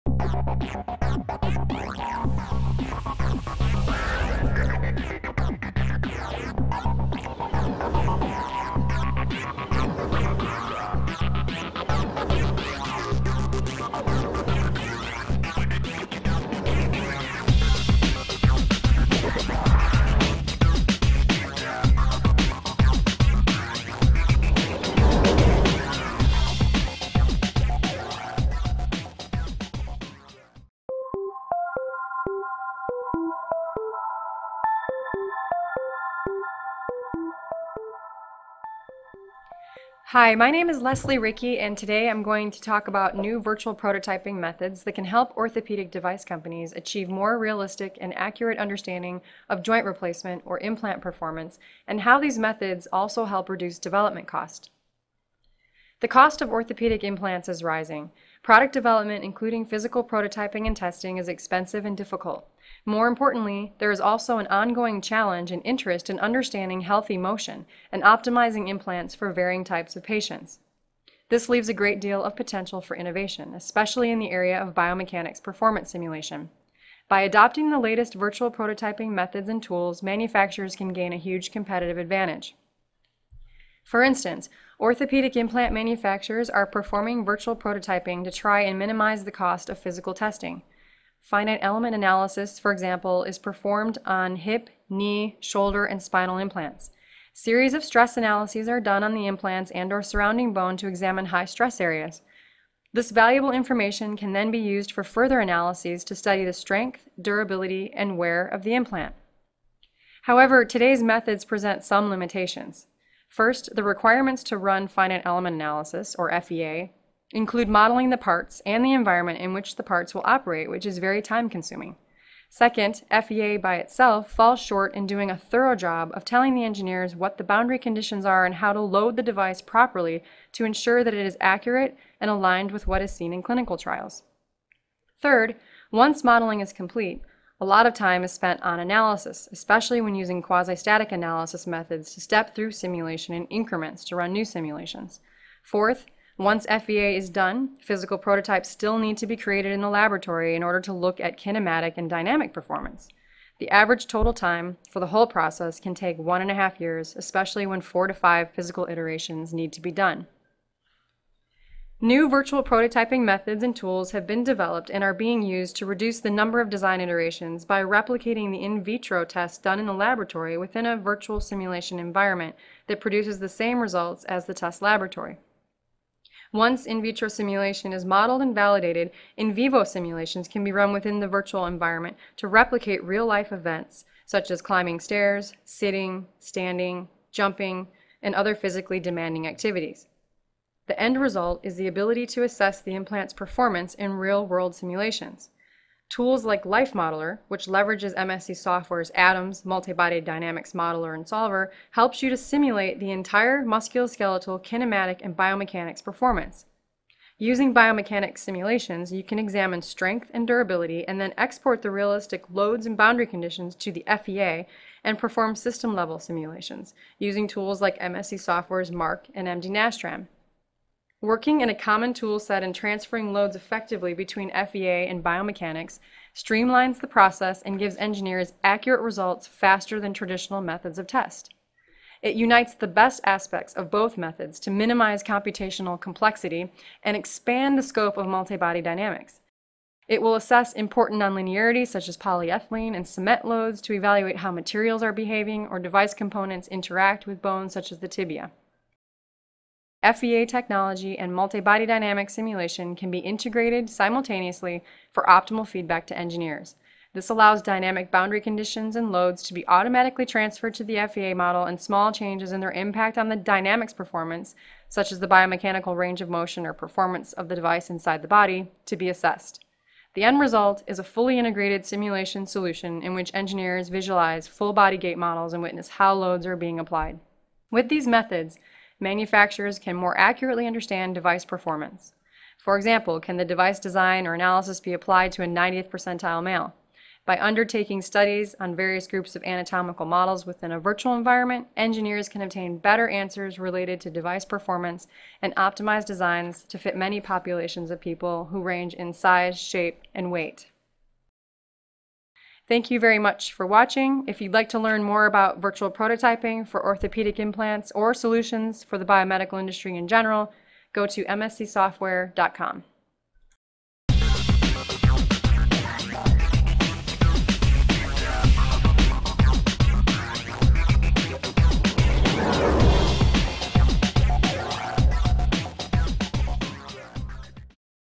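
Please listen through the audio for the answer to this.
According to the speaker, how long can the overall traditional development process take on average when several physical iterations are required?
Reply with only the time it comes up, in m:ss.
2:36.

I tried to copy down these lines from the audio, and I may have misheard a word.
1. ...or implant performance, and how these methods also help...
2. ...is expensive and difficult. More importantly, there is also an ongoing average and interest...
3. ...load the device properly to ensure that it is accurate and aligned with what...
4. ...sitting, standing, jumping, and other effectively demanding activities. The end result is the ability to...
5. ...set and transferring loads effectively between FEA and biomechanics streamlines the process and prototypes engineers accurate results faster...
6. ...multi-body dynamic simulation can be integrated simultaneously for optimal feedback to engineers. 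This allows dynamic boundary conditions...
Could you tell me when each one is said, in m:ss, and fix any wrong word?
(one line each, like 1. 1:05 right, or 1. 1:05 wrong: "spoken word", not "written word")
1. 0:50 right
2. 1:01 wrong: "challenge", not "average"
3. 2:08 right
4. 3:05 wrong: "physically", not "effectively"
5. 3:42 wrong: "gives", not "prototypes"
6. 4:11 right.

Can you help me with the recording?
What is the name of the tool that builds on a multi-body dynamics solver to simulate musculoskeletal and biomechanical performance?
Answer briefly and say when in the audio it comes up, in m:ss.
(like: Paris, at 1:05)
Life Modeler, at 3:16.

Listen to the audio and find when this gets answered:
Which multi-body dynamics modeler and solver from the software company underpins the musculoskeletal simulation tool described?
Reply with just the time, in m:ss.
3:19.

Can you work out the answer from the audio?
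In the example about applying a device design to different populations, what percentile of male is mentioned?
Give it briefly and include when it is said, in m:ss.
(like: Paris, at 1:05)
90th, at 4:45.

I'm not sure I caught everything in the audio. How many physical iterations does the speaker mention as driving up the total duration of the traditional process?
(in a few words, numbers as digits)
4 to 5.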